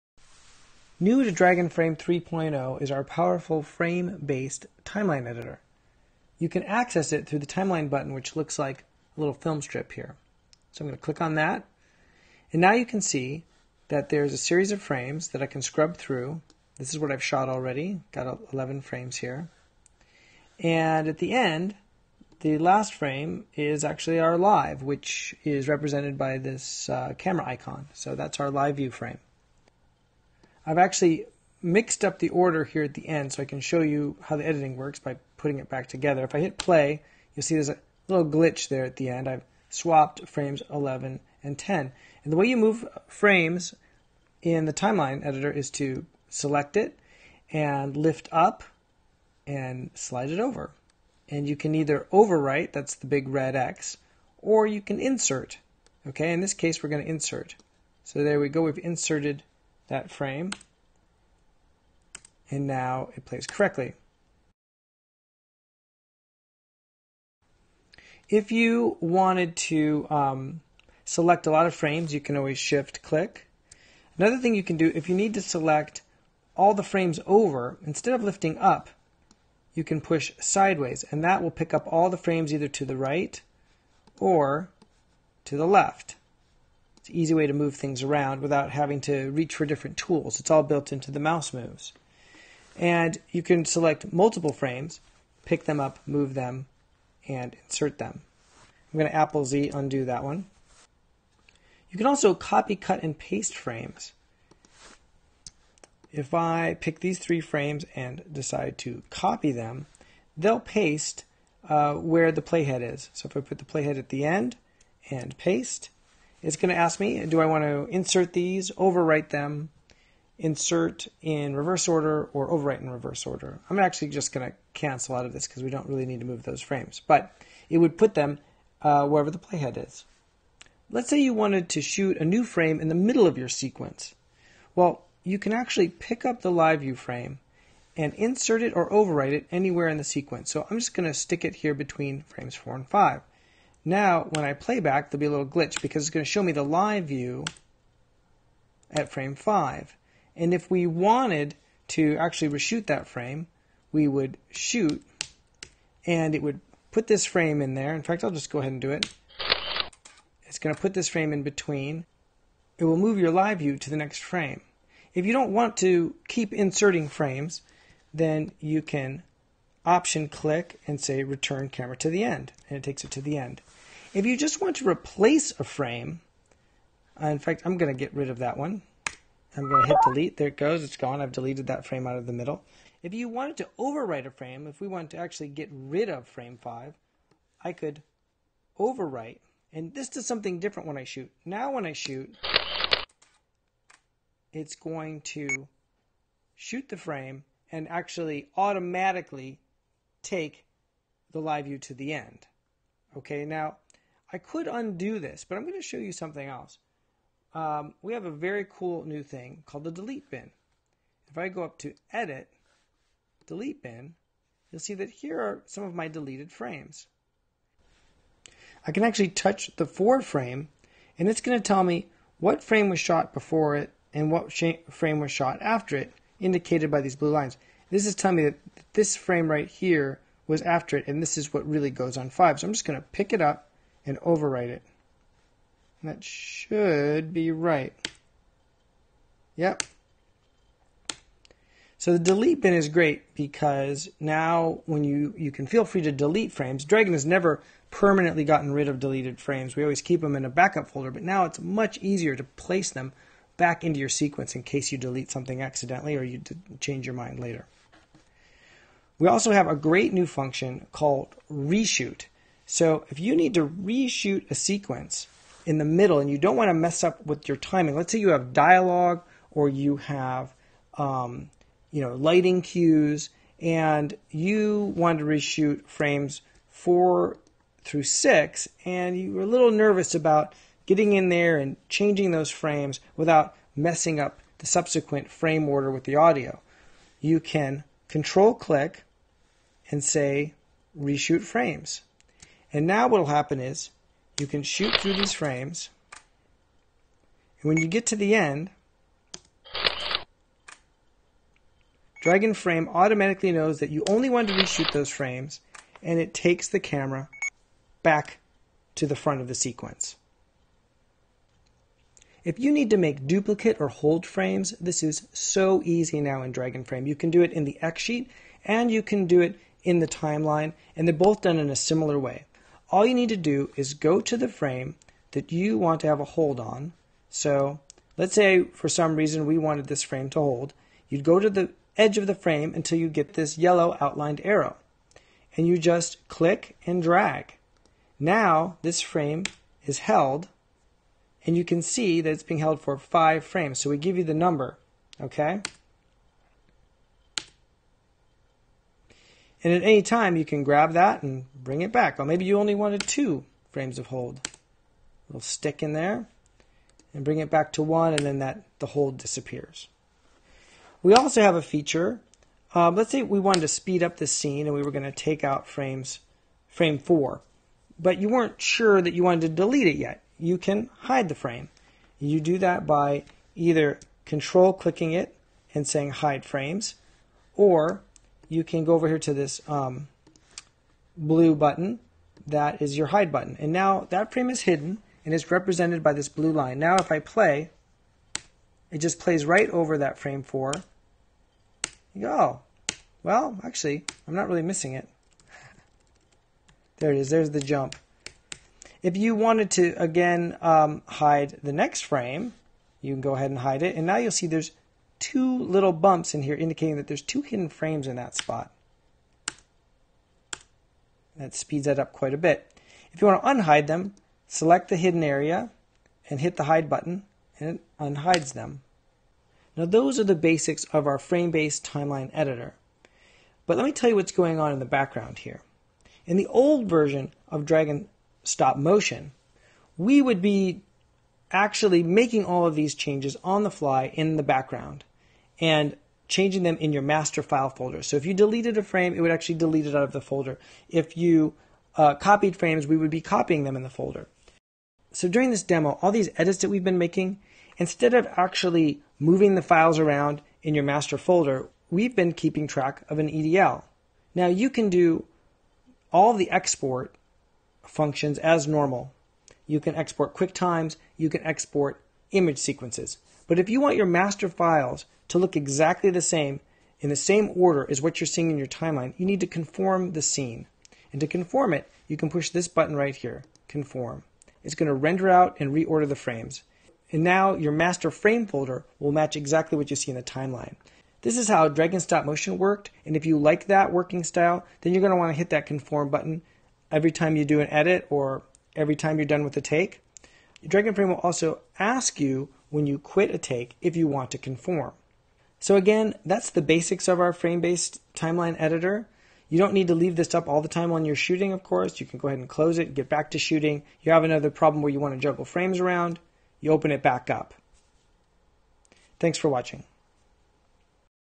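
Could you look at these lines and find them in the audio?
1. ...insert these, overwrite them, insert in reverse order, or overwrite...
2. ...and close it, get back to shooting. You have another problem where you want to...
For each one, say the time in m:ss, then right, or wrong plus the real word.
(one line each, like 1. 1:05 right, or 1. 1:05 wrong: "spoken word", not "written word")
1. 1:57 right
2. 8:22 right.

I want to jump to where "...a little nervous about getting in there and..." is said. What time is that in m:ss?
4:39.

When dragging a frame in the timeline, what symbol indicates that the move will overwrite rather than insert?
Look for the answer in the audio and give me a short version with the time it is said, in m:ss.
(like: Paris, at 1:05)
big red X, at 0:53.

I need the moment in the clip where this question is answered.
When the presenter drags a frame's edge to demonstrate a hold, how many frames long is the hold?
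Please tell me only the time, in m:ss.
5:42.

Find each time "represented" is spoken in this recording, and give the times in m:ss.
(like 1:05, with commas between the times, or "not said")
0:25, 6:25.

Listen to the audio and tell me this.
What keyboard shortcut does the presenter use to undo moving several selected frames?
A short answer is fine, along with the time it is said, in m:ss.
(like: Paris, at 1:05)
Apple Z, at 1:39.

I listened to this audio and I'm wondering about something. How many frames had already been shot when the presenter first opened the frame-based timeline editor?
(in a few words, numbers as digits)
11.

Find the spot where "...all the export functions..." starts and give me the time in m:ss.
7:36.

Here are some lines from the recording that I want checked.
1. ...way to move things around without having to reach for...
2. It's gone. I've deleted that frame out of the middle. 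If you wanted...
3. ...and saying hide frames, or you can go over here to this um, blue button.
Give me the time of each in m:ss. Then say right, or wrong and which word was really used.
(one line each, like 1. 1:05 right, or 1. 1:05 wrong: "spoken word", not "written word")
1. 1:27 right
2. 3:00 right
3. 6:15 right.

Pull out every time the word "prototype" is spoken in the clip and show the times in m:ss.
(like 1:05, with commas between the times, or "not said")
not said.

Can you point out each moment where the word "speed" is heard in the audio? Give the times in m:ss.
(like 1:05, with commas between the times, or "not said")
6:03, 6:51.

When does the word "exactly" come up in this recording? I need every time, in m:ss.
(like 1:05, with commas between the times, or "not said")
7:45, 7:59.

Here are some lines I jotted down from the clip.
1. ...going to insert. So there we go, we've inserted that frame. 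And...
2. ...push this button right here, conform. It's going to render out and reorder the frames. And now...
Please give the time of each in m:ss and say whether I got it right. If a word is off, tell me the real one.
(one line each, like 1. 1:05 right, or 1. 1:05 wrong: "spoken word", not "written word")
1. 0:56 right
2. 7:52 right.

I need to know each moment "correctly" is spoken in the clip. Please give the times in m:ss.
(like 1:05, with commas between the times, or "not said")
1:03.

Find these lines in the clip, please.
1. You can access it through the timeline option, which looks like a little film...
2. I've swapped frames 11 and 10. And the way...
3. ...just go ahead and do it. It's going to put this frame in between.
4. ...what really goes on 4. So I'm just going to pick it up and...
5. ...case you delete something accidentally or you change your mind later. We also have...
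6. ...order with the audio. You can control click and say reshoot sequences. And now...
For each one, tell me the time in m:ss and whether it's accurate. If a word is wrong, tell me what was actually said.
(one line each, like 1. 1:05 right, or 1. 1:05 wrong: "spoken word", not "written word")
1. 0:06 wrong: "button", not "option"
2. 0:39 right
3. 2:38 right
4. 3:51 wrong: "5", not "4"
5. 4:14 right
6. 4:45 wrong: "frames", not "sequences".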